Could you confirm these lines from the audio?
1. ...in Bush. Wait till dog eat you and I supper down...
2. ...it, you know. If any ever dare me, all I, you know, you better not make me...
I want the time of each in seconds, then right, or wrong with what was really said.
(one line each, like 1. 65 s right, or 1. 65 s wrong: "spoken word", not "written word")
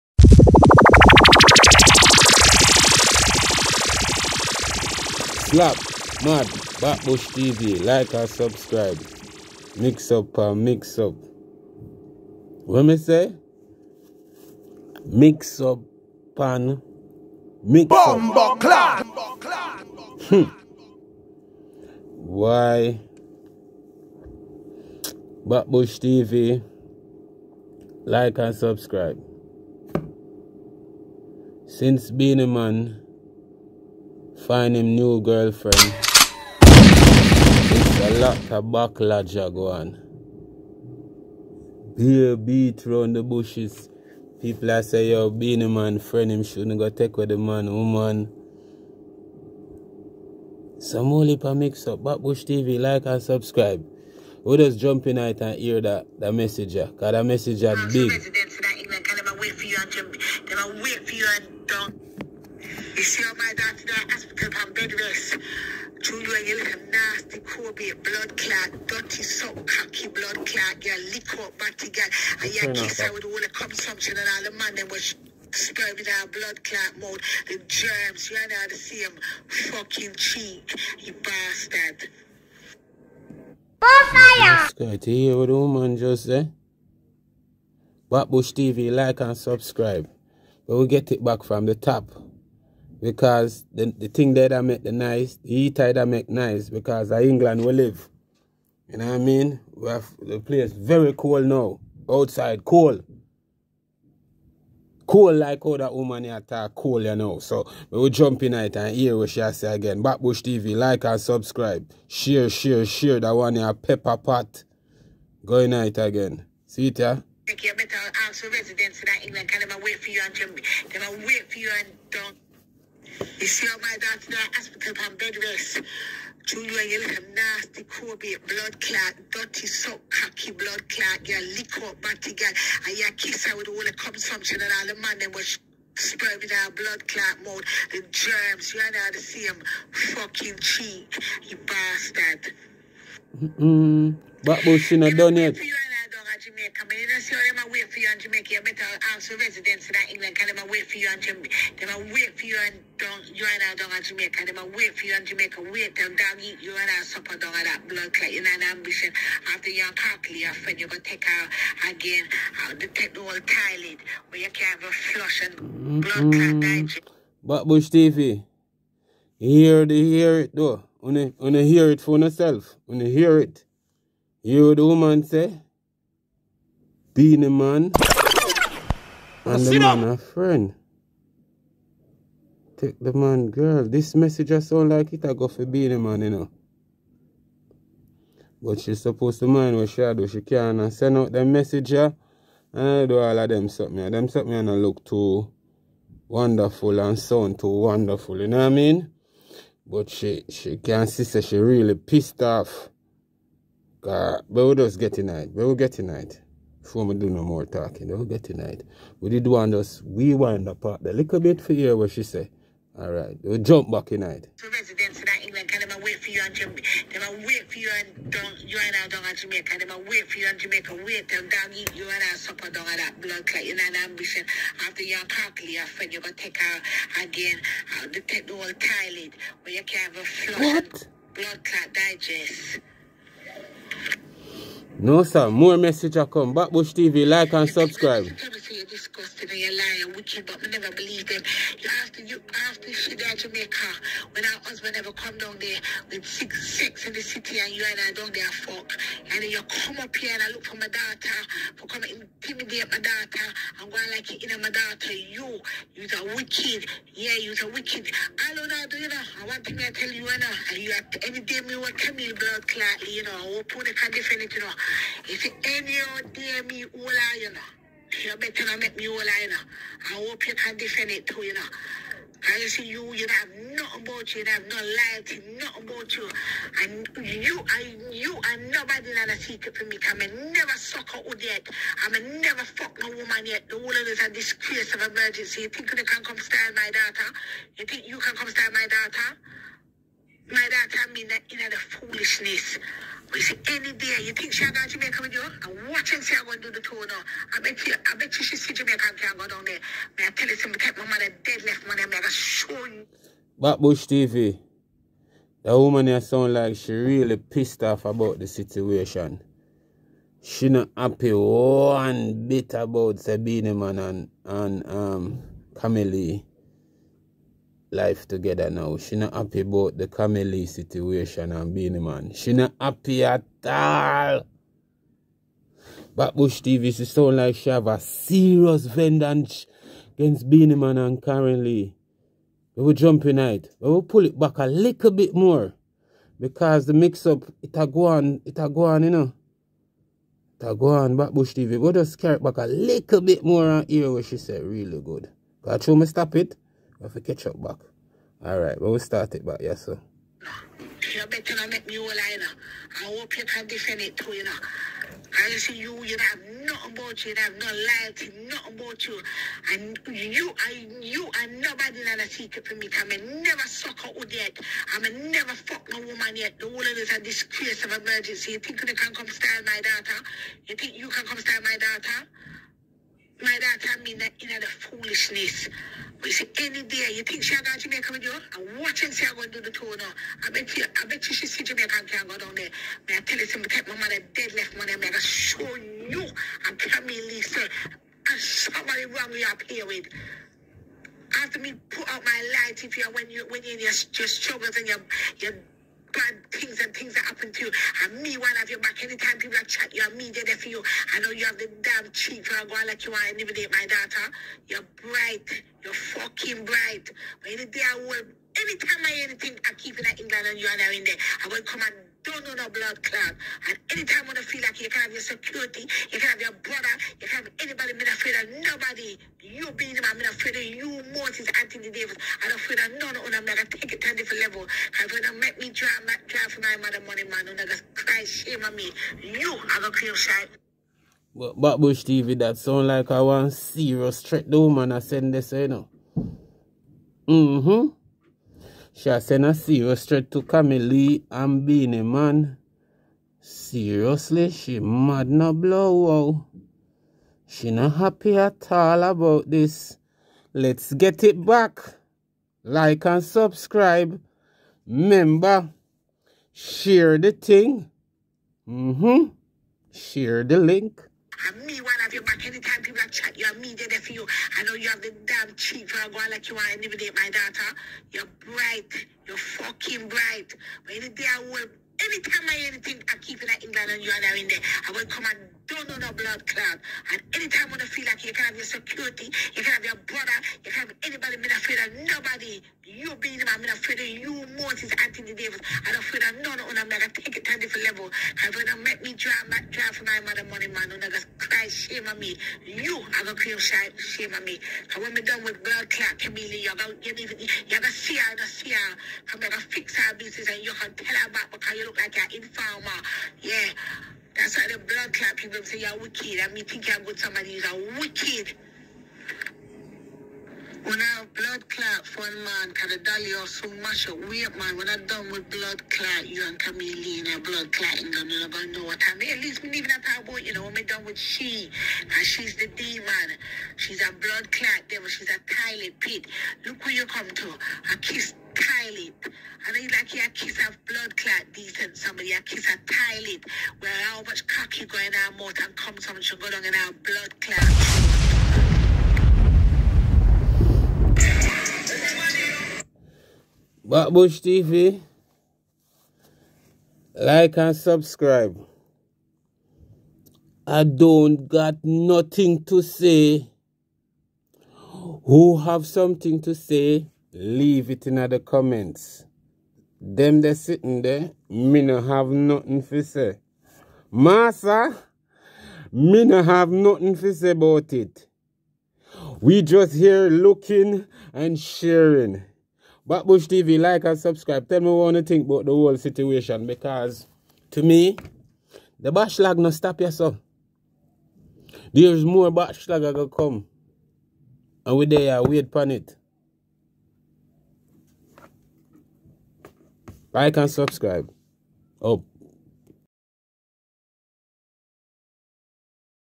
1. 155 s wrong: "Jamaica", not "Bush"
2. 264 s right.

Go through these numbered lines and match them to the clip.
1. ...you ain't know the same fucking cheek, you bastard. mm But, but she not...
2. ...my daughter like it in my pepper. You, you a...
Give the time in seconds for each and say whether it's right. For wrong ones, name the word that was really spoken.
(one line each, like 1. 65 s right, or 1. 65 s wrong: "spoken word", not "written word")
1. 138 s right
2. 252 s wrong: "daughter", not "pepper".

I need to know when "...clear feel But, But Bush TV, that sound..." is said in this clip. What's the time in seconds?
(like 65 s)
429 s.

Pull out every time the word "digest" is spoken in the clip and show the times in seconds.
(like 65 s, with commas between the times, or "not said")
166 s, 231 s.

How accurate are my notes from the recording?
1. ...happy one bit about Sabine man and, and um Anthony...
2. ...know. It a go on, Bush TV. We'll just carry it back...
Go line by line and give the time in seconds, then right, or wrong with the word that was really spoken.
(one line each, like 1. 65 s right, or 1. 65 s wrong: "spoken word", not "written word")
1. 310 s wrong: "Camille", not "Anthony"
2. 339 s right.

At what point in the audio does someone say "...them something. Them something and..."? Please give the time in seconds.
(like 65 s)
193 s.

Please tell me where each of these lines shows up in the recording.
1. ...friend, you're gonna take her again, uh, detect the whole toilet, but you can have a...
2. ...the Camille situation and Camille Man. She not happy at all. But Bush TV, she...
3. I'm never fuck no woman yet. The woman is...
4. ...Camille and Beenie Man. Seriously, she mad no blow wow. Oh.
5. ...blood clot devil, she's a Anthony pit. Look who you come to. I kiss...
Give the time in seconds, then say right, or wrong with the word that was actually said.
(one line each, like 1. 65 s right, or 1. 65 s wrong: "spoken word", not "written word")
1. 225 s right
2. 319 s wrong: "Beenie", not "Camille"
3. 364 s right
4. 440 s right
5. 524 s wrong: "Tyler", not "Anthony".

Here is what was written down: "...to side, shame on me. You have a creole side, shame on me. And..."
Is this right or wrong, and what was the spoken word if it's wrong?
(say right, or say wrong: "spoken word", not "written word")
right.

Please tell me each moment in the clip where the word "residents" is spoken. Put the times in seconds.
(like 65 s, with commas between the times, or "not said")
118 s, 149 s, 214 s.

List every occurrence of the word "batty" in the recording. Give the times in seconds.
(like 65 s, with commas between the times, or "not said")
71 s, 132 s.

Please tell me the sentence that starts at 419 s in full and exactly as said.
You Beenie Man, I'm afraid of you, Moses, Anthony Davis.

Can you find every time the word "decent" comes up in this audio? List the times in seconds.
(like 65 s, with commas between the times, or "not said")
531 s.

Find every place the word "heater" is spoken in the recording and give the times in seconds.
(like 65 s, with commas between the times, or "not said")
95 s.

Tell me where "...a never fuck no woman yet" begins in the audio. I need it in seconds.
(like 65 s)
282 s.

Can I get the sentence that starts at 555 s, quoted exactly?
Who have something to say, leave it in the comments.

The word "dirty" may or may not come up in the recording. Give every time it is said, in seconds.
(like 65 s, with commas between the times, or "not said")
68 s, 129 s.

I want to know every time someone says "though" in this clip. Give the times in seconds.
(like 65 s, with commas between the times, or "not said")
170 s, 434 s.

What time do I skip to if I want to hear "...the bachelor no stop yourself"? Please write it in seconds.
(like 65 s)
578 s.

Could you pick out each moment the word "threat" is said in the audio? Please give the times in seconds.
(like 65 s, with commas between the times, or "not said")
434 s, 440 s.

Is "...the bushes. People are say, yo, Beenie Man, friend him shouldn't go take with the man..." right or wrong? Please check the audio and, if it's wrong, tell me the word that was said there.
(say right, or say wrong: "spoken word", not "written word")
right.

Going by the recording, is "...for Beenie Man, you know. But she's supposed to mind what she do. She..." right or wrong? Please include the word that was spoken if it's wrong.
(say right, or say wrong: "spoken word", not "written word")
right.